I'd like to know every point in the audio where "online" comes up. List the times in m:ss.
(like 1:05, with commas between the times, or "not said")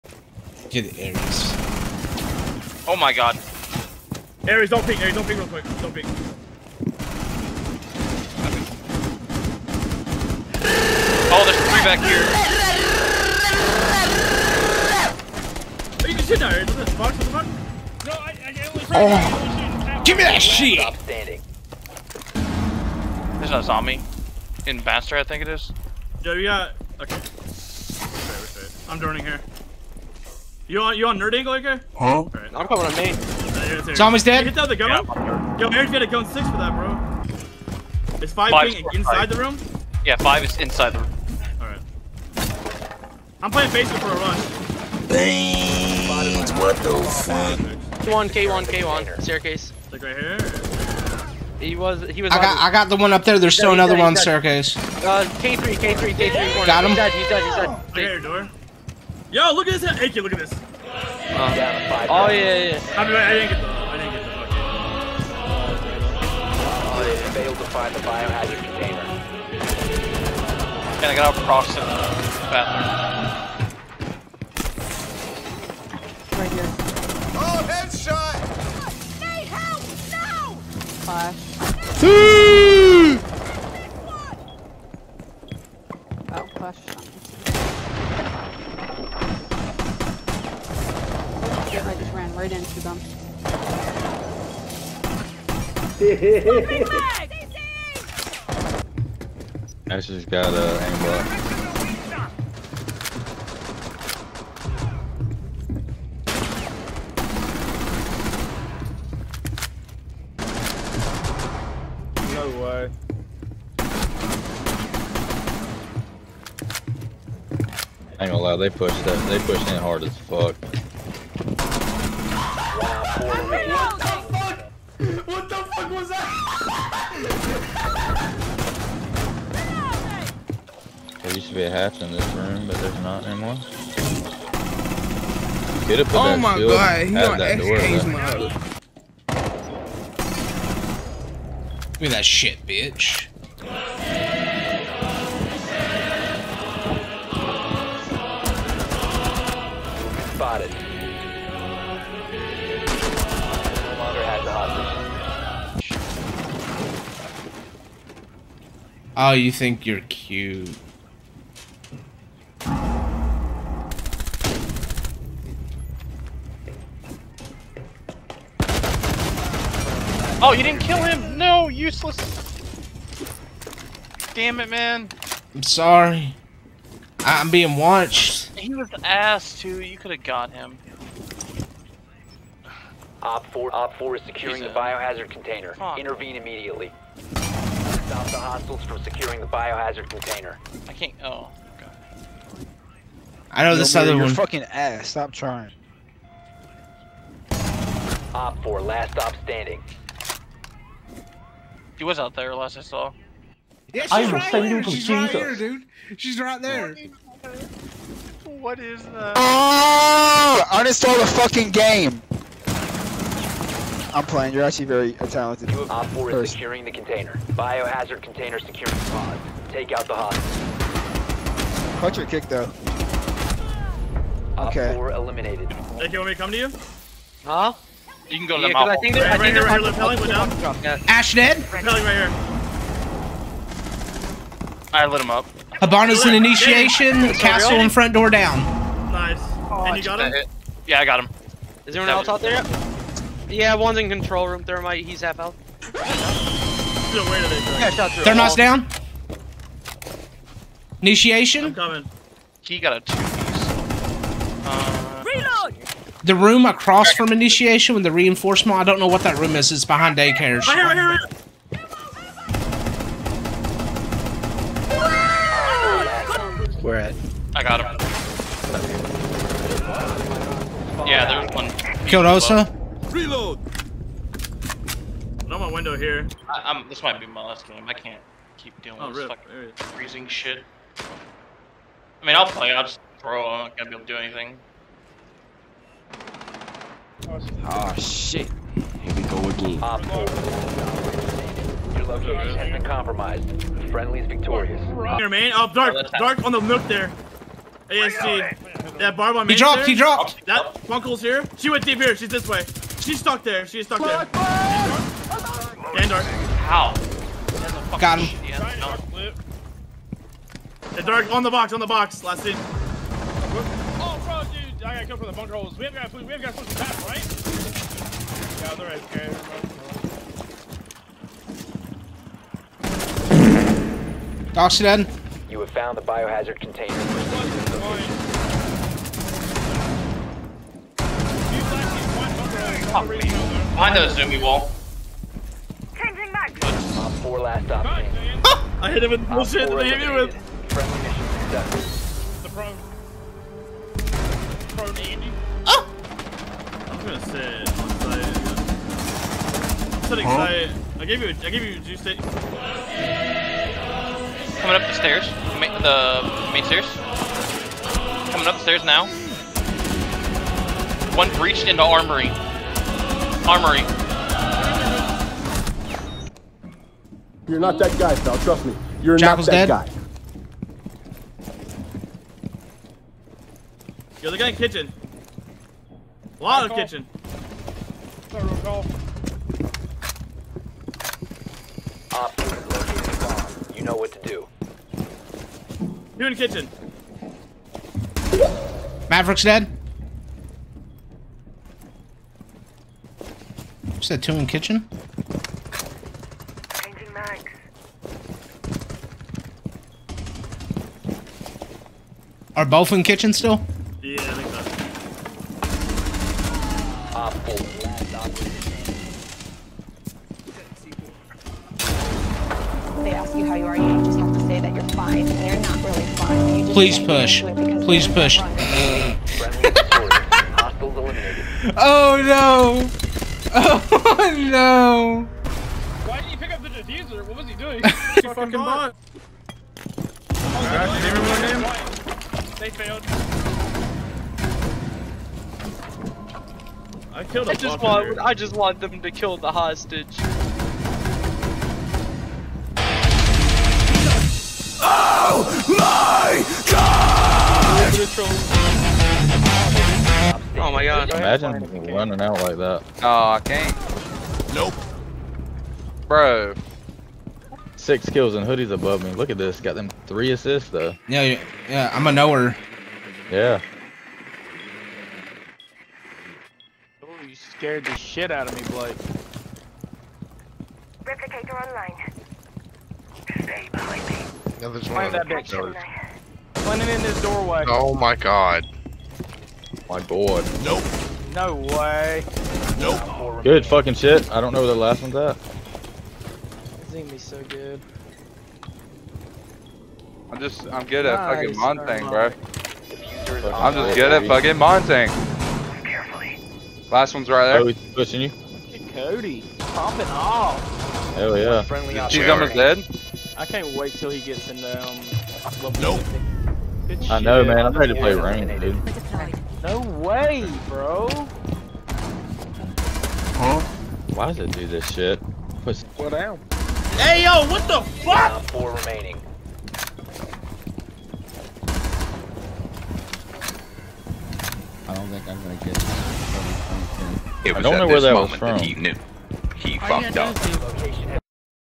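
7:51.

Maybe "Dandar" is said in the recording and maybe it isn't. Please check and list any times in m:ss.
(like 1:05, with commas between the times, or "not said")
5:05.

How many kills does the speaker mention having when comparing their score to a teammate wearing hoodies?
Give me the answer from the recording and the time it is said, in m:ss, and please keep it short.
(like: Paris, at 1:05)
6, at 7:37.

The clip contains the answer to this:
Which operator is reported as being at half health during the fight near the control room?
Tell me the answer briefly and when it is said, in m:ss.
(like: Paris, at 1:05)
Thermite, at 4:04.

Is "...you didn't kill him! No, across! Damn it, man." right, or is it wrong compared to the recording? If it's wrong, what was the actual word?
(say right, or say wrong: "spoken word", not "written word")
wrong: "useless", not "across".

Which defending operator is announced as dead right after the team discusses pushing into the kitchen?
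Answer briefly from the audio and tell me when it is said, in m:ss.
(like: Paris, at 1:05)
Maverick, at 6:29.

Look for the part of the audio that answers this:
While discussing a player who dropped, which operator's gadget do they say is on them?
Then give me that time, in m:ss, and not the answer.
4:58.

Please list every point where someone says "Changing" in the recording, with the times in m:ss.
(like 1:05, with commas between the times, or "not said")
5:35, 6:36.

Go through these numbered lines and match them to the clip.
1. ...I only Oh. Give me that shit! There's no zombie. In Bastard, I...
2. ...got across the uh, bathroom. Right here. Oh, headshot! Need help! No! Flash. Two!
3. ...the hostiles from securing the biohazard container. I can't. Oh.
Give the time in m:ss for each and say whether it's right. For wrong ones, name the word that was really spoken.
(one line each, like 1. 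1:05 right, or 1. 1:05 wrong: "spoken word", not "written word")
1. 0:18 right
2. 1:11 right
3. 3:08 right.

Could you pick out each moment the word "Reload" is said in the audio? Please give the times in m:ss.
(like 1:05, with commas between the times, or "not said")
4:15, 4:33.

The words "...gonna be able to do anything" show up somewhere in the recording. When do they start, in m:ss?
4:43.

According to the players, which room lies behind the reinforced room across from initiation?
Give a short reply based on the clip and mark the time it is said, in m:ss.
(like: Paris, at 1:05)
Daycare, at 4:19.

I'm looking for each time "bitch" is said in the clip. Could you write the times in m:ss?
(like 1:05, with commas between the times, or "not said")
2:22, 7:55.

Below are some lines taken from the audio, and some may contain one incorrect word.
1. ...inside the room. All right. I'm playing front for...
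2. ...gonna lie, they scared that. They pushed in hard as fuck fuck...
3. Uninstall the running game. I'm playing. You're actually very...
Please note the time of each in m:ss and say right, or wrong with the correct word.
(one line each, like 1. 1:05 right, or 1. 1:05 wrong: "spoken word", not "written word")
1. 0:40 wrong: "basement", not "front"
2. 1:58 wrong: "pushed", not "scared"
3. 3:30 wrong: "fucking", not "running".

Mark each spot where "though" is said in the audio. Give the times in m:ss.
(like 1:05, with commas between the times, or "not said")
3:42, 7:40.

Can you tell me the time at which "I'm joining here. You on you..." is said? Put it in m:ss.
0:28.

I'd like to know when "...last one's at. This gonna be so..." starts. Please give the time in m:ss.
8:04.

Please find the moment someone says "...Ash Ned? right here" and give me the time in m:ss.
3:51.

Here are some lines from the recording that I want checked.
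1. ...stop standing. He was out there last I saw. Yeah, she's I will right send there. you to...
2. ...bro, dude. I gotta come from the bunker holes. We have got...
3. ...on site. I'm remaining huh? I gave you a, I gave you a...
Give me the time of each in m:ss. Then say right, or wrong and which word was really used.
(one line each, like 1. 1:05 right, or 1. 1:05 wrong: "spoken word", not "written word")
1. 3:19 right
2. 5:14 right
3. 5:47 wrong: "setting", not "remaining".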